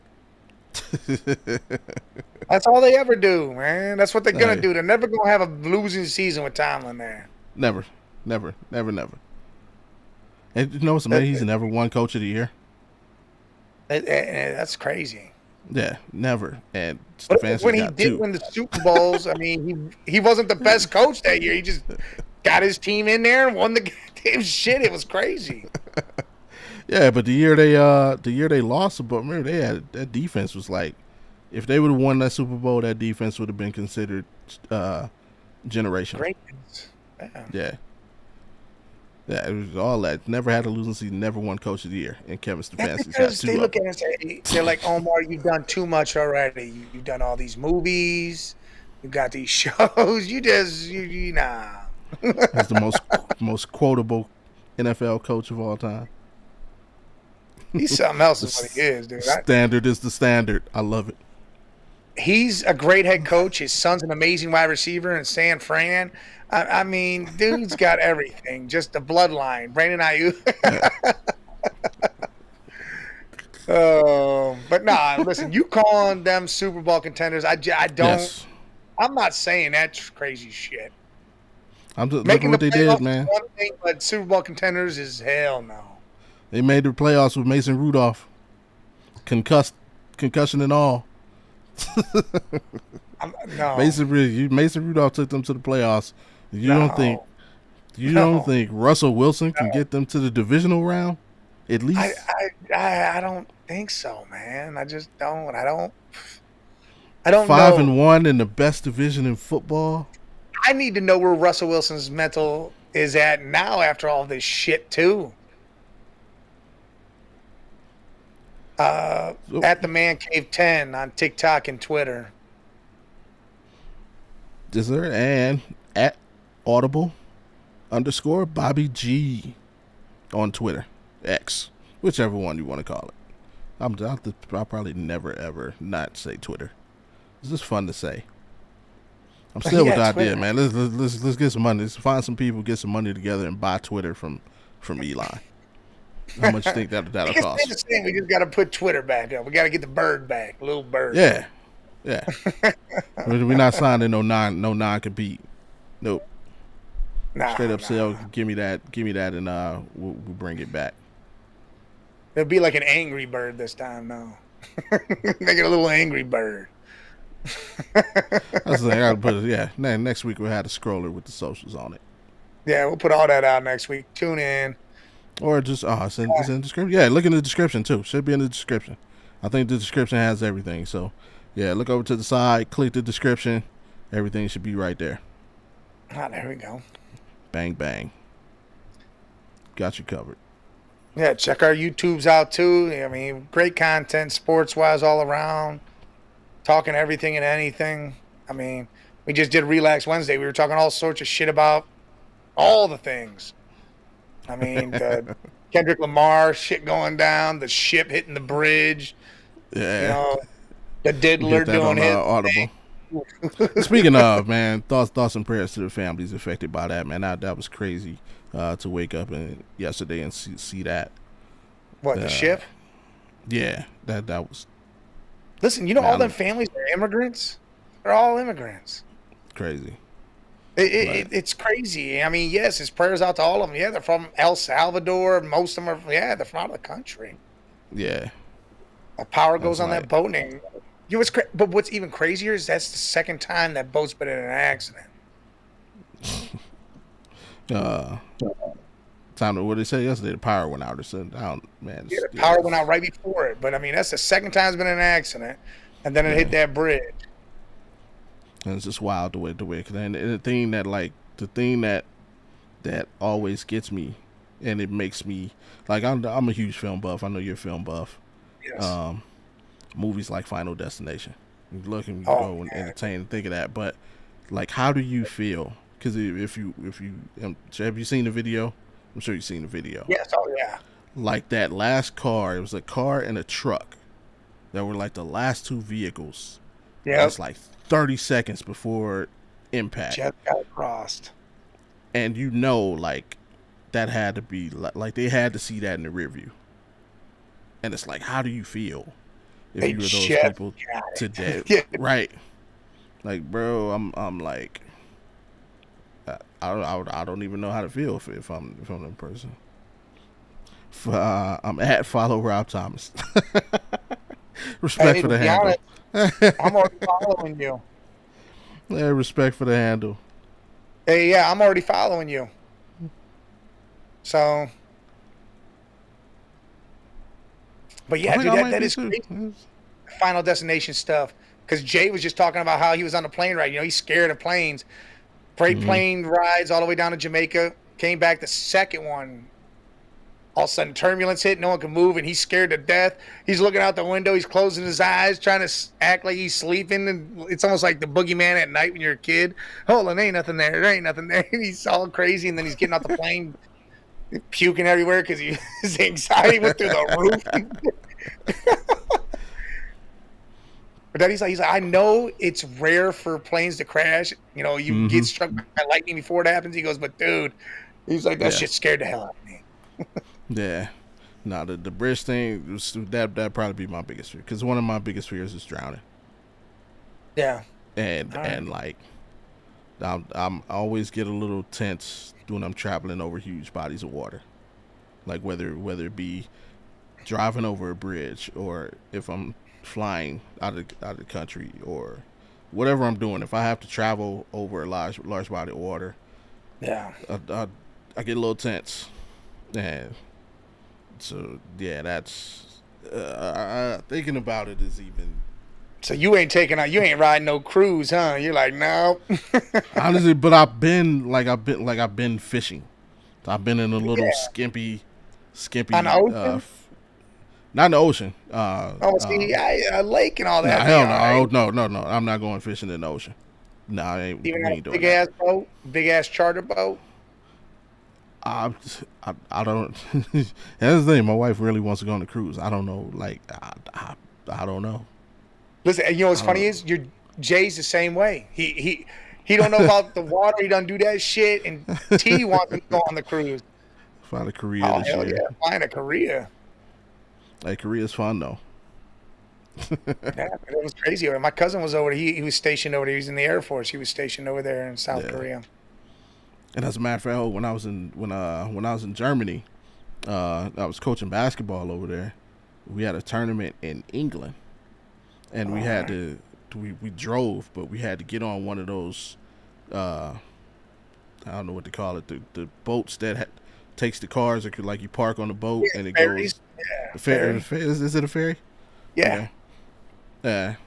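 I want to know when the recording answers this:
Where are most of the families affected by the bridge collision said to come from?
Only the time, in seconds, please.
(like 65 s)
234 s.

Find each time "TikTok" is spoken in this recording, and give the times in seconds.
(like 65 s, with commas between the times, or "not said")
121 s.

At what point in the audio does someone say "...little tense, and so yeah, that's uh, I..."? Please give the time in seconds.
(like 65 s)
398 s.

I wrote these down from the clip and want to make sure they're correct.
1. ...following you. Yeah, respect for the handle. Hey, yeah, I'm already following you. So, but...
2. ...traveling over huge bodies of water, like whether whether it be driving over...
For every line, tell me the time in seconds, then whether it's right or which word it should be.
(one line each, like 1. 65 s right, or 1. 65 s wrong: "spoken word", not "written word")
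1. 317 s right
2. 382 s right.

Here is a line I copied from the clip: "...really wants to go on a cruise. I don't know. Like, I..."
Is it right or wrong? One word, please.
right.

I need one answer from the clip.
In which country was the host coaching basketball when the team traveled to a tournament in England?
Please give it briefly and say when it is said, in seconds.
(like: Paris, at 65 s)
Germany, at 459 s.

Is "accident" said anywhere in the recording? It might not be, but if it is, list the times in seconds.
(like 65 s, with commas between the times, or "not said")
244 s, 254 s.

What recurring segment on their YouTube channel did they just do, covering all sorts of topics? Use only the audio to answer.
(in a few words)
Relax Wednesday.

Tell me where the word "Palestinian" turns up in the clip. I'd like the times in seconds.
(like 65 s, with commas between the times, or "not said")
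not said.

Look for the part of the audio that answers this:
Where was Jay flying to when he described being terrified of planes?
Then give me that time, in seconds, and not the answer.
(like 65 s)
337 s.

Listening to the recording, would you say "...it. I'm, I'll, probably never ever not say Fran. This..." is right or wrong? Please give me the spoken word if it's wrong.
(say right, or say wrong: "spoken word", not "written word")
wrong: "Twitter", not "Fran".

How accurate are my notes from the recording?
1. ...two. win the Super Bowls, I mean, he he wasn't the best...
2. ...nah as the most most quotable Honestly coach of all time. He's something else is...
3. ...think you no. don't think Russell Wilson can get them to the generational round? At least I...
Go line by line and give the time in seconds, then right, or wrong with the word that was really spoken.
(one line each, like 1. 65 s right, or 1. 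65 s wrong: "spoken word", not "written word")
1. 17 s right
2. 51 s wrong: "NFL", not "Honestly"
3. 96 s wrong: "divisional", not "generational".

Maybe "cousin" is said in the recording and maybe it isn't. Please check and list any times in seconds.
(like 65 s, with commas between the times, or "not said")
451 s.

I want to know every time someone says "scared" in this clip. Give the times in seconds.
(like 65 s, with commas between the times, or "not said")
333 s, 342 s, 368 s.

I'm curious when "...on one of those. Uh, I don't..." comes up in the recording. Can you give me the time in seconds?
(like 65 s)
468 s.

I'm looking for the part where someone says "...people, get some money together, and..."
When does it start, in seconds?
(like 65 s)
142 s.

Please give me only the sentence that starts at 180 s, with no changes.
So yeah, look over to the side, click the description.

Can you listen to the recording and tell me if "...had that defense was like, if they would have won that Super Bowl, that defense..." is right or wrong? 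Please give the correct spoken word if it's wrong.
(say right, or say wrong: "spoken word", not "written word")
right.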